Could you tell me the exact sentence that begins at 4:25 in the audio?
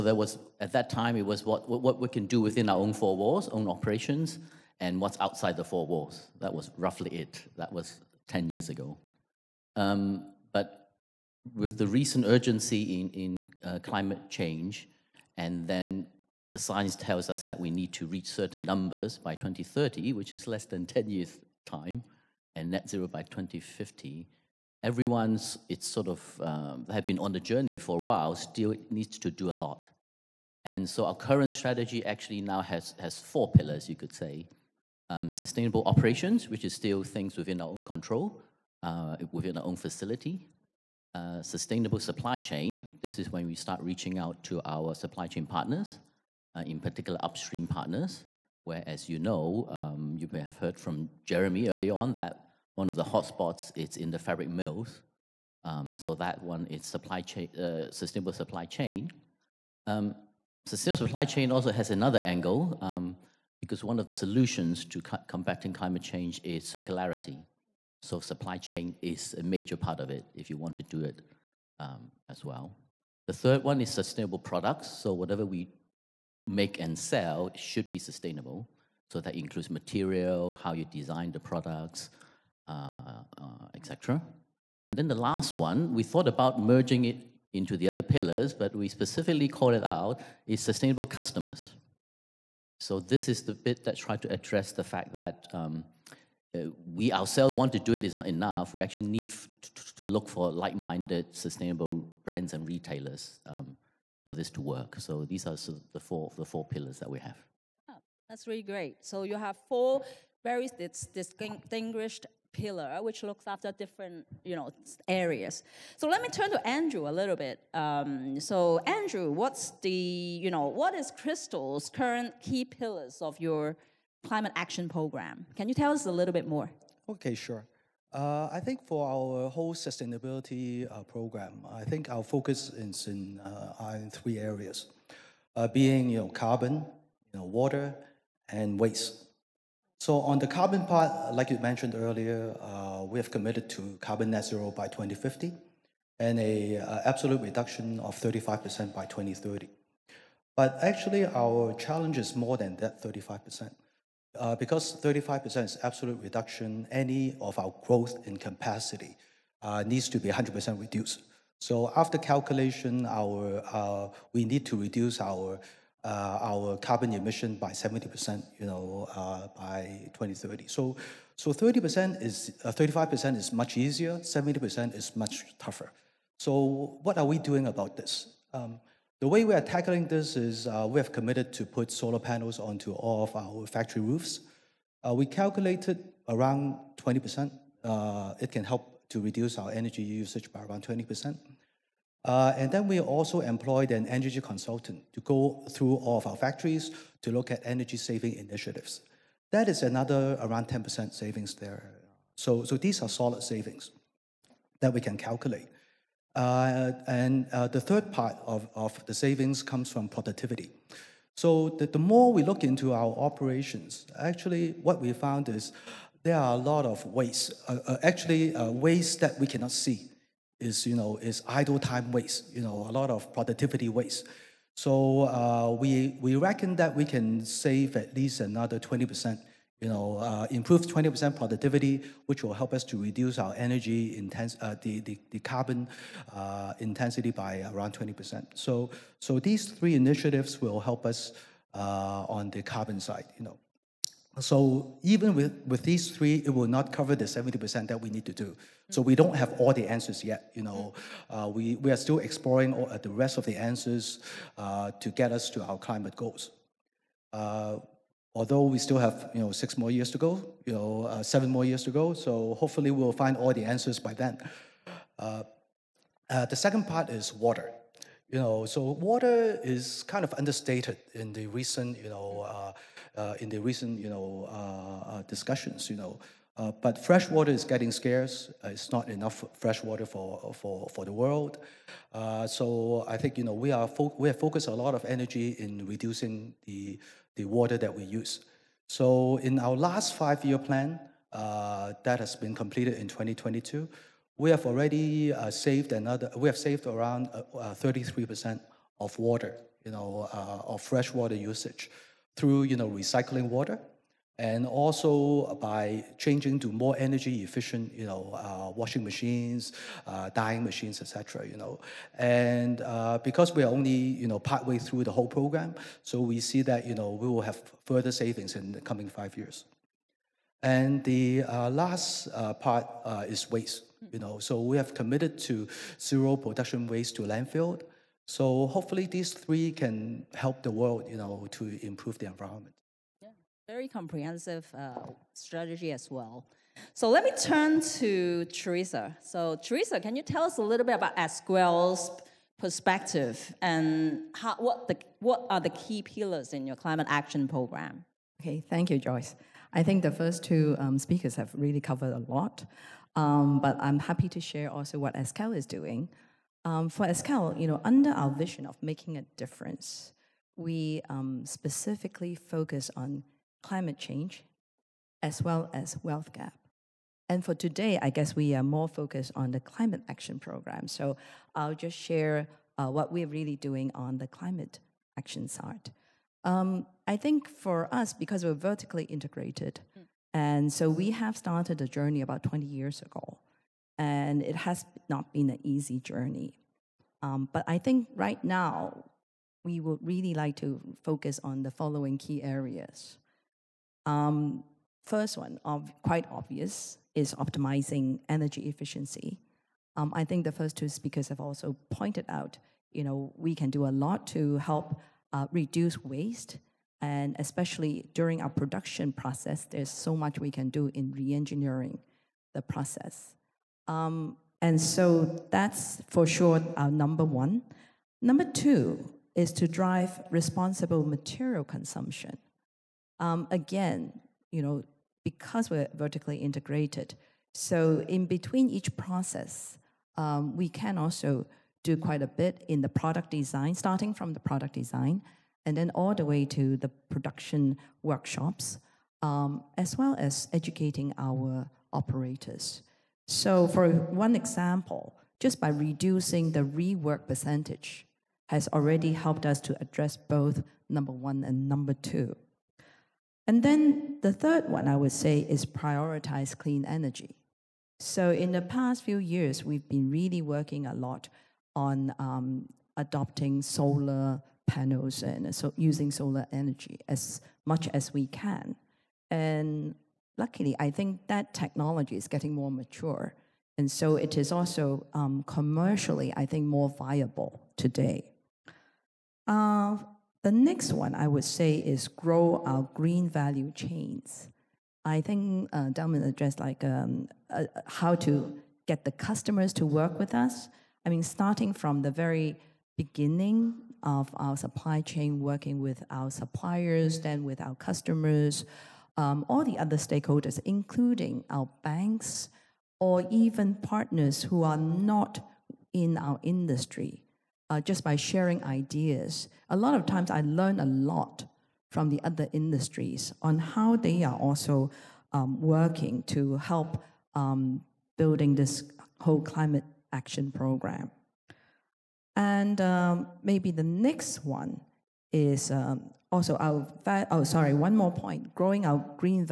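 Uh, uh, the second part is water.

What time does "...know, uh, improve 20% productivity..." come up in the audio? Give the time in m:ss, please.
3:49.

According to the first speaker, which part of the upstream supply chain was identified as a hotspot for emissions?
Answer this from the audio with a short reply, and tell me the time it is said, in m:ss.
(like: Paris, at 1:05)
Fabric mills, at 0:54.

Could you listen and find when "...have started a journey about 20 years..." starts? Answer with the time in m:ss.
6:21.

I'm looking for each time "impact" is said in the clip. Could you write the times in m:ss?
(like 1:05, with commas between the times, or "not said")
not said.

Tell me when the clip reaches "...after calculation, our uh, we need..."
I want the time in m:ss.
2:41.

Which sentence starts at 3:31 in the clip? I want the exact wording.
So the, the more we look into our operations, actually what we found is there are a lot of waste.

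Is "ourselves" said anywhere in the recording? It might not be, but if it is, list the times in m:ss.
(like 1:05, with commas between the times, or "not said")
1:37.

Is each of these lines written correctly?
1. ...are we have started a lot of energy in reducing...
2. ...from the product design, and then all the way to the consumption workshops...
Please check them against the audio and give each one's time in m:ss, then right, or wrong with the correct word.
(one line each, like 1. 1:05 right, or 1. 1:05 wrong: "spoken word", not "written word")
1. 4:43 wrong: "focused", not "started"
2. 7:14 wrong: "production", not "consumption".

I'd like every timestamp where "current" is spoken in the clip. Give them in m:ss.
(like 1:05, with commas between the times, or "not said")
0:31, 2:01.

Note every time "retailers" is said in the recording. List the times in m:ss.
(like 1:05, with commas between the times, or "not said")
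1:42.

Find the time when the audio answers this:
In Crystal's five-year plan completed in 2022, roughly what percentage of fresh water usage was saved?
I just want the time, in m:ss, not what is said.
4:57.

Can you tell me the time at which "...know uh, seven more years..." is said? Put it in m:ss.
4:20.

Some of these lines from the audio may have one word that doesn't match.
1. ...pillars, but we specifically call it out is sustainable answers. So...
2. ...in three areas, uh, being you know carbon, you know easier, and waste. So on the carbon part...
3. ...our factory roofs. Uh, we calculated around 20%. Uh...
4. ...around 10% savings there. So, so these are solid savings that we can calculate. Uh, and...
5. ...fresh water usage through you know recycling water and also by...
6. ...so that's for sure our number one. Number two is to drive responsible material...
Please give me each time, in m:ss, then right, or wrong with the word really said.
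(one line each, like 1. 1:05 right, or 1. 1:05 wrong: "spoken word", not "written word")
1. 1:28 wrong: "customers", not "answers"
2. 2:13 wrong: "water", not "easier"
3. 3:03 right
4. 3:20 right
5. 5:00 right
6. 6:54 right.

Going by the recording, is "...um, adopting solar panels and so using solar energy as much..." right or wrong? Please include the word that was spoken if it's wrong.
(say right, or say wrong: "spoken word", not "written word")
right.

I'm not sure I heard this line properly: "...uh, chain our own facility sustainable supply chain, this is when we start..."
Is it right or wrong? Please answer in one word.
wrong.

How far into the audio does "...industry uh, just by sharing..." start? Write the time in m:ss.
8:26.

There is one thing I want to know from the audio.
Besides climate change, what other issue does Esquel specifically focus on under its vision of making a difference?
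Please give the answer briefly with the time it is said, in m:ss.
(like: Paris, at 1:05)
Wealth gap, at 6:06.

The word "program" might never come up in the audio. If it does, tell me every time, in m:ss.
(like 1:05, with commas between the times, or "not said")
2:04, 2:11, 5:15, 5:47, 6:10, 8:40.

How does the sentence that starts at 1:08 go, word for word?
So supply chain is a major part of it if you want to do it um, as well.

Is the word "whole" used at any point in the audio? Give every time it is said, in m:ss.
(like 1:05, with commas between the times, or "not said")
2:09, 5:15, 8:39.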